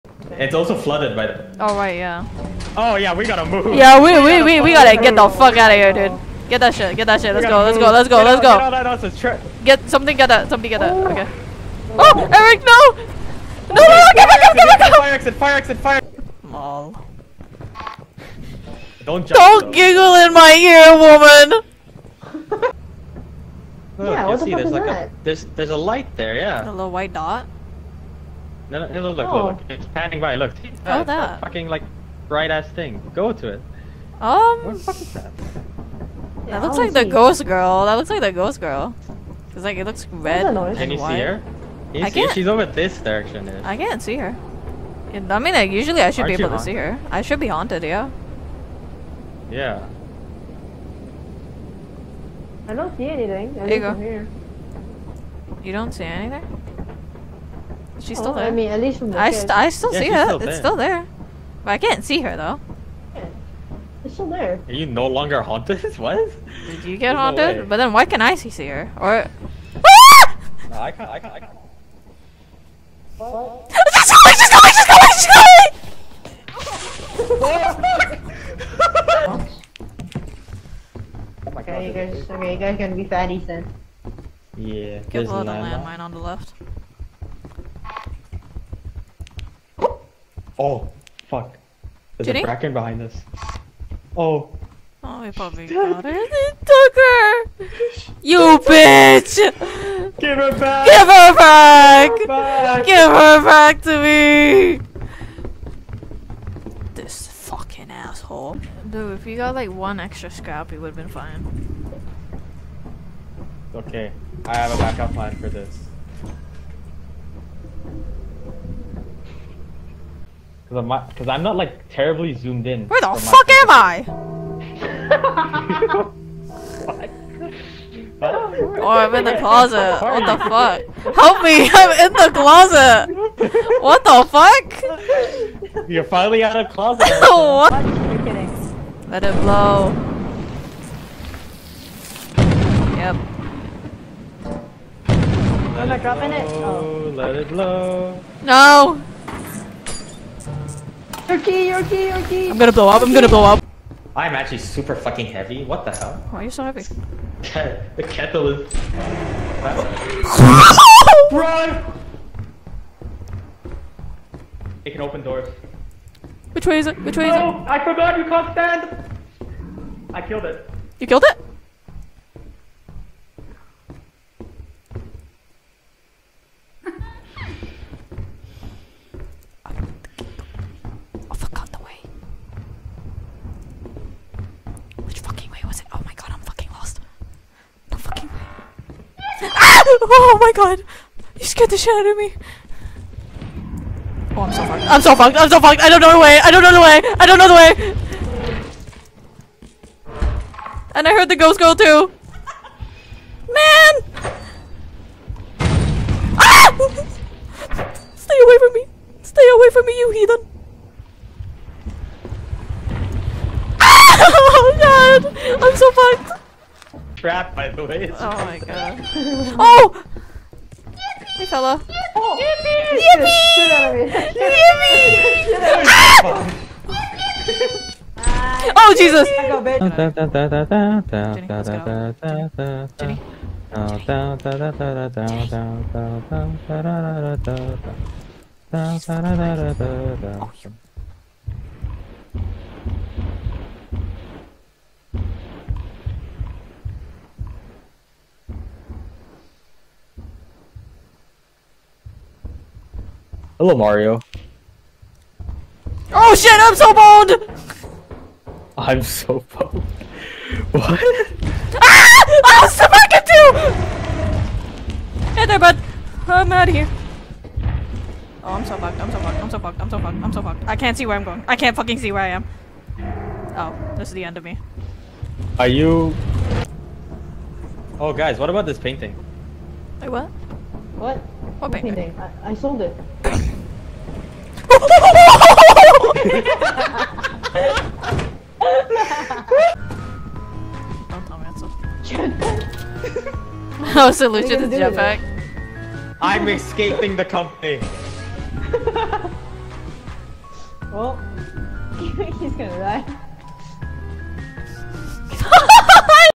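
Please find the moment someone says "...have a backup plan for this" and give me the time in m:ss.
1:54.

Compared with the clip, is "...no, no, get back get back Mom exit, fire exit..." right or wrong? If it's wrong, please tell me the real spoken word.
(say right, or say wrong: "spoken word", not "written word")
wrong: "Fire", not "Mom".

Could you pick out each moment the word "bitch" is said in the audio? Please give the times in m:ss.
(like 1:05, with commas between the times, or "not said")
1:38, 3:49.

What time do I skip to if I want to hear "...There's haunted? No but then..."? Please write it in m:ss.
1:07.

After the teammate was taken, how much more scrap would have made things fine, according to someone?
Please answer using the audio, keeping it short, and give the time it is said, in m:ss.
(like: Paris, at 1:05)
1, at 1:49.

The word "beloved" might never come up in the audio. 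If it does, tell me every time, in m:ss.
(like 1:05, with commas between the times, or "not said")
not said.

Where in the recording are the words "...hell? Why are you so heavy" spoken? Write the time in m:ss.
2:35.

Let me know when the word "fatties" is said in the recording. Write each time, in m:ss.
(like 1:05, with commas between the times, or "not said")
1:23.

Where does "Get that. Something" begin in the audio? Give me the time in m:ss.
0:10.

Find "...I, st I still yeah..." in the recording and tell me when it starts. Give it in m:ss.
0:59.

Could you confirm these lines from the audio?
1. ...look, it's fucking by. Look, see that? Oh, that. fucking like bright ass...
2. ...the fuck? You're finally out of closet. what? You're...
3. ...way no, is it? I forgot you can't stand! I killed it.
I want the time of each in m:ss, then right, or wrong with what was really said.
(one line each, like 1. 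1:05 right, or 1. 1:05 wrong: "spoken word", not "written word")
1. 0:29 wrong: "panning", not "fucking"
2. 2:14 right
3. 2:47 right.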